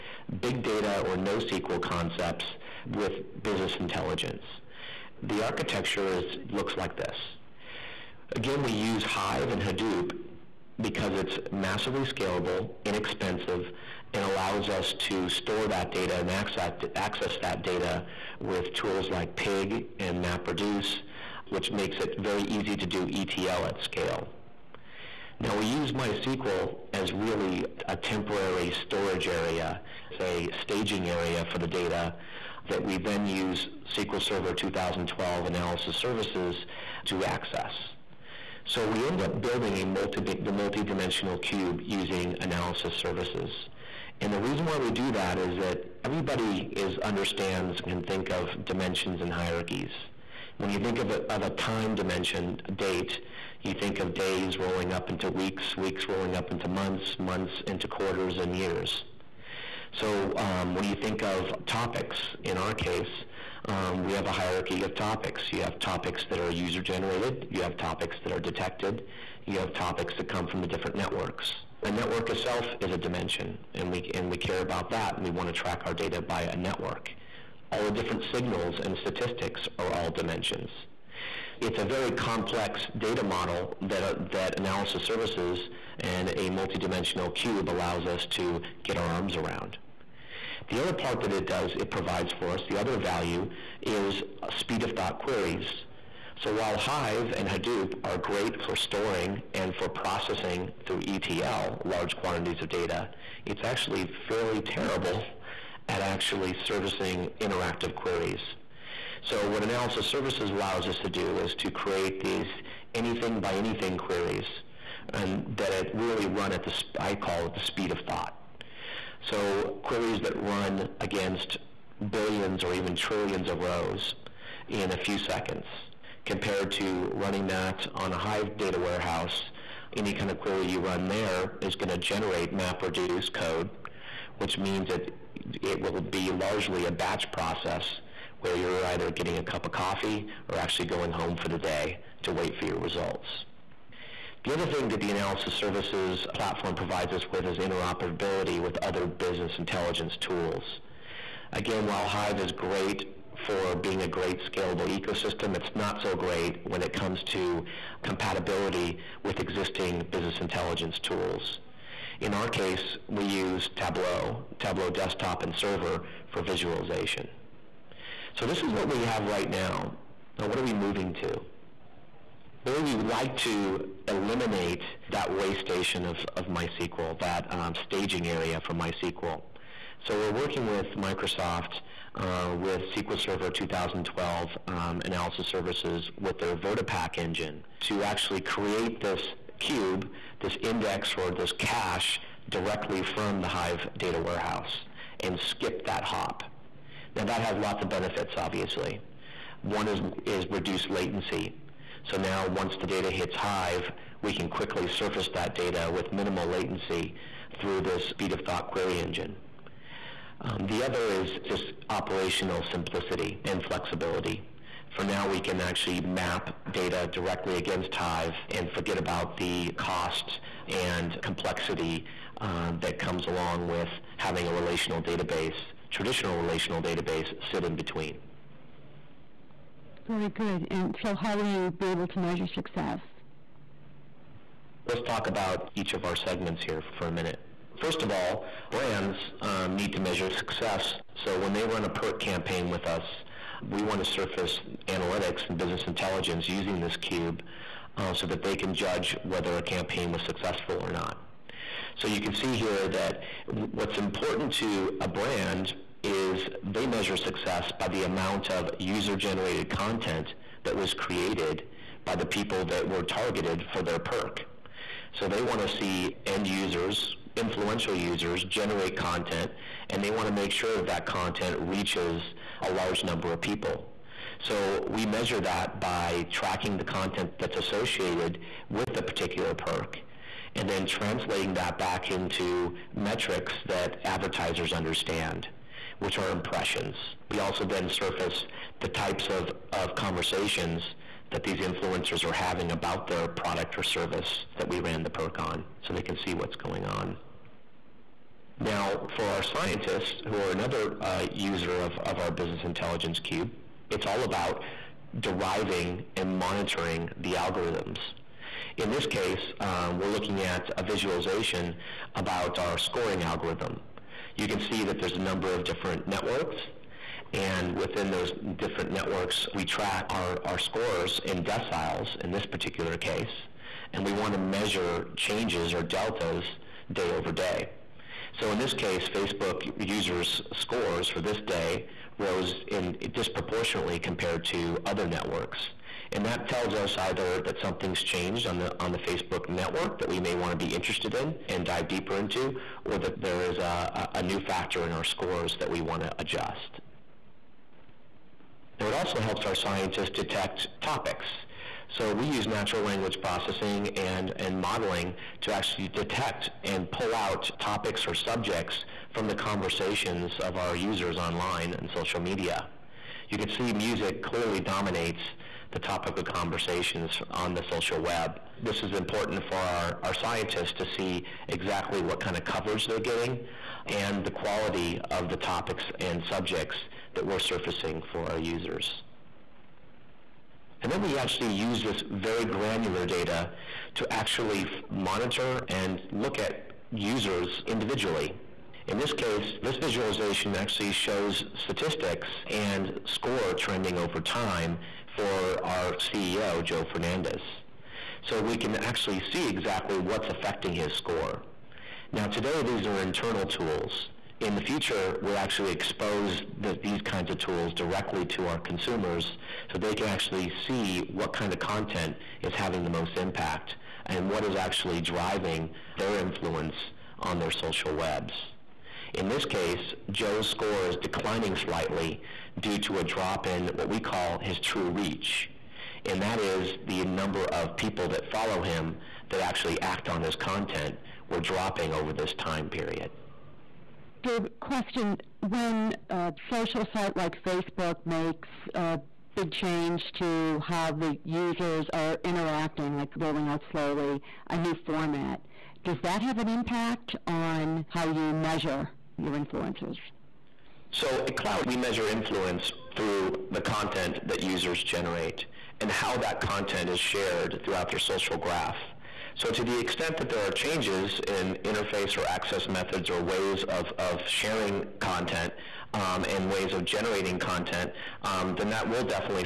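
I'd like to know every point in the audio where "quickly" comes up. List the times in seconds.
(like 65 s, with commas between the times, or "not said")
204 s.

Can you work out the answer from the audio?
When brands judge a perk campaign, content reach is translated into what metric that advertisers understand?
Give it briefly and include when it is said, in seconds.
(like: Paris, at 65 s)
impressions, at 286 s.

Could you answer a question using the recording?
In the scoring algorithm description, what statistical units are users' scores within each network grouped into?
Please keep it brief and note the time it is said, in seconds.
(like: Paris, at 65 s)
deciles, at 321 s.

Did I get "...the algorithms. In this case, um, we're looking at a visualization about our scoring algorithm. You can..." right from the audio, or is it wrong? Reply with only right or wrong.
right.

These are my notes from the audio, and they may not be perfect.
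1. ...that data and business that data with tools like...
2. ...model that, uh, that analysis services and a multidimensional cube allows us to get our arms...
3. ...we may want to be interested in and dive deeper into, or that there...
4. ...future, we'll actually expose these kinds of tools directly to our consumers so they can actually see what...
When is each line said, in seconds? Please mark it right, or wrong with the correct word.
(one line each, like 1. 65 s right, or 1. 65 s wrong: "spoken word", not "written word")
1. 15 s wrong: "access", not "business"
2. 83 s right
3. 340 s right
4. 404 s right.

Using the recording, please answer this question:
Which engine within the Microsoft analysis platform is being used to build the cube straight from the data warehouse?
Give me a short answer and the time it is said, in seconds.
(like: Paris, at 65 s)
VertiPaq, at 186 s.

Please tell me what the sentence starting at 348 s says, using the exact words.
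Now, it also helps our scientists detect topics.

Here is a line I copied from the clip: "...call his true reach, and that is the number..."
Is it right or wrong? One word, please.
right.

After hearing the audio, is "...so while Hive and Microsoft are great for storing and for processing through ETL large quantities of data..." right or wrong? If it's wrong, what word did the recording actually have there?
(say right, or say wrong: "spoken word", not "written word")
wrong: "Hadoop", not "Microsoft".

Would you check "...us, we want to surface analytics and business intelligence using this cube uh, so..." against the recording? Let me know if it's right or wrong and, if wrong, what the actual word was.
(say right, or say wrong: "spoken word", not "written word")
right.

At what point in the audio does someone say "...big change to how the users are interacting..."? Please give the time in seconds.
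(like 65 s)
439 s.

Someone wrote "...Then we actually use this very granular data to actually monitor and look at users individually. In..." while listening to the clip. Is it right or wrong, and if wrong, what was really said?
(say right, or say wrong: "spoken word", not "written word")
right.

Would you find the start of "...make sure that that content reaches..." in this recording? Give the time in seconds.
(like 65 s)
270 s.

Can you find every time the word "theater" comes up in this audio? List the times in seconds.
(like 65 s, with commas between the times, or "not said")
not said.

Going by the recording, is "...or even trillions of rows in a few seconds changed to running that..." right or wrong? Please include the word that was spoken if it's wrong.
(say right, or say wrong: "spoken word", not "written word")
wrong: "compared", not "changed".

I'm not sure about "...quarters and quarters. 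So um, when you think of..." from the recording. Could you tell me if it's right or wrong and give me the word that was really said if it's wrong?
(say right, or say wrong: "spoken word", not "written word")
wrong: "years", not "quarters".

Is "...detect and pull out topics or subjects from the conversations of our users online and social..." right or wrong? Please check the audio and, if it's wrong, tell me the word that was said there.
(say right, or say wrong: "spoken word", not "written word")
right.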